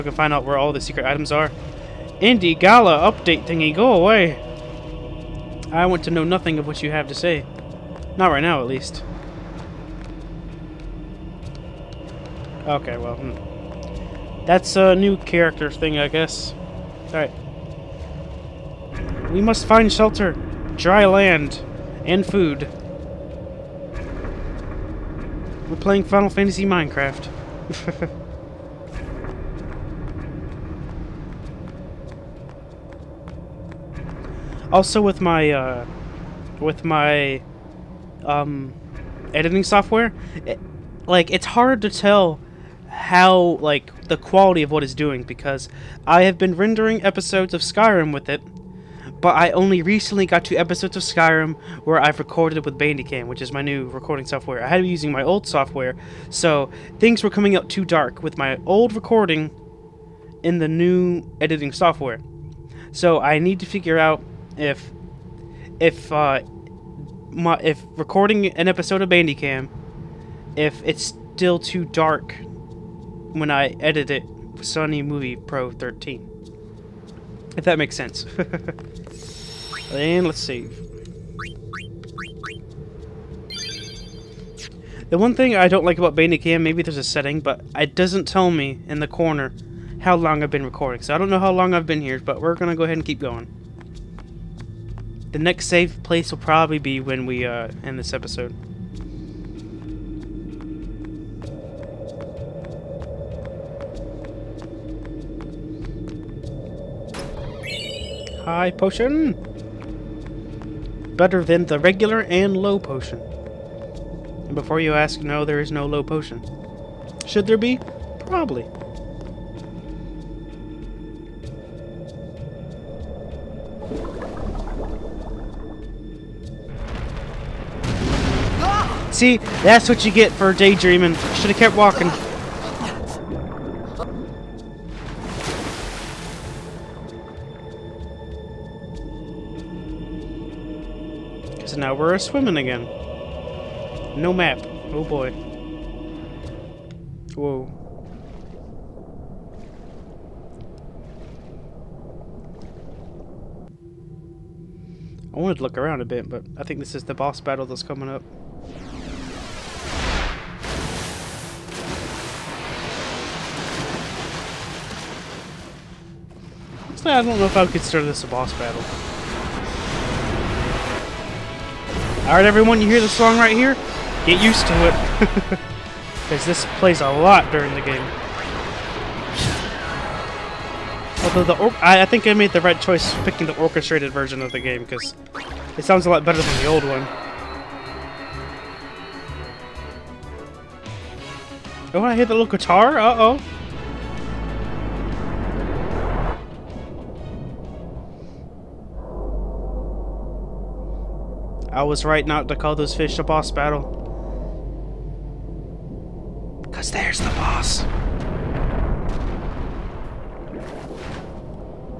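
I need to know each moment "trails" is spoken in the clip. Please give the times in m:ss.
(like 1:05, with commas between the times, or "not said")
not said.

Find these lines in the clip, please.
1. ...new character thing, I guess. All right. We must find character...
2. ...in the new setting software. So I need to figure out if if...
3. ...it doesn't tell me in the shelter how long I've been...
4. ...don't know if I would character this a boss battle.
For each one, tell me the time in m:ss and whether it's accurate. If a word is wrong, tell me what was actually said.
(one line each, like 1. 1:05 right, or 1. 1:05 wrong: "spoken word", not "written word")
1. 0:14 wrong: "shelter", not "character"
2. 1:00 wrong: "editing", not "setting"
3. 1:27 wrong: "corner", not "shelter"
4. 2:47 wrong: "consider", not "character".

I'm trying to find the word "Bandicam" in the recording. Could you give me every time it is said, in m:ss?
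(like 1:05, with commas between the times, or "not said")
0:52, 1:09, 1:26.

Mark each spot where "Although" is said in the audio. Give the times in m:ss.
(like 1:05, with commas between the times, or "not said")
3:01.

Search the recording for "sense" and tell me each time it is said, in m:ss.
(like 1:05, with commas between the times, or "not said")
1:17.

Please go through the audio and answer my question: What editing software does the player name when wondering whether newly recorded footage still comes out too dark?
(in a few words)
Sony Movie Pro 13.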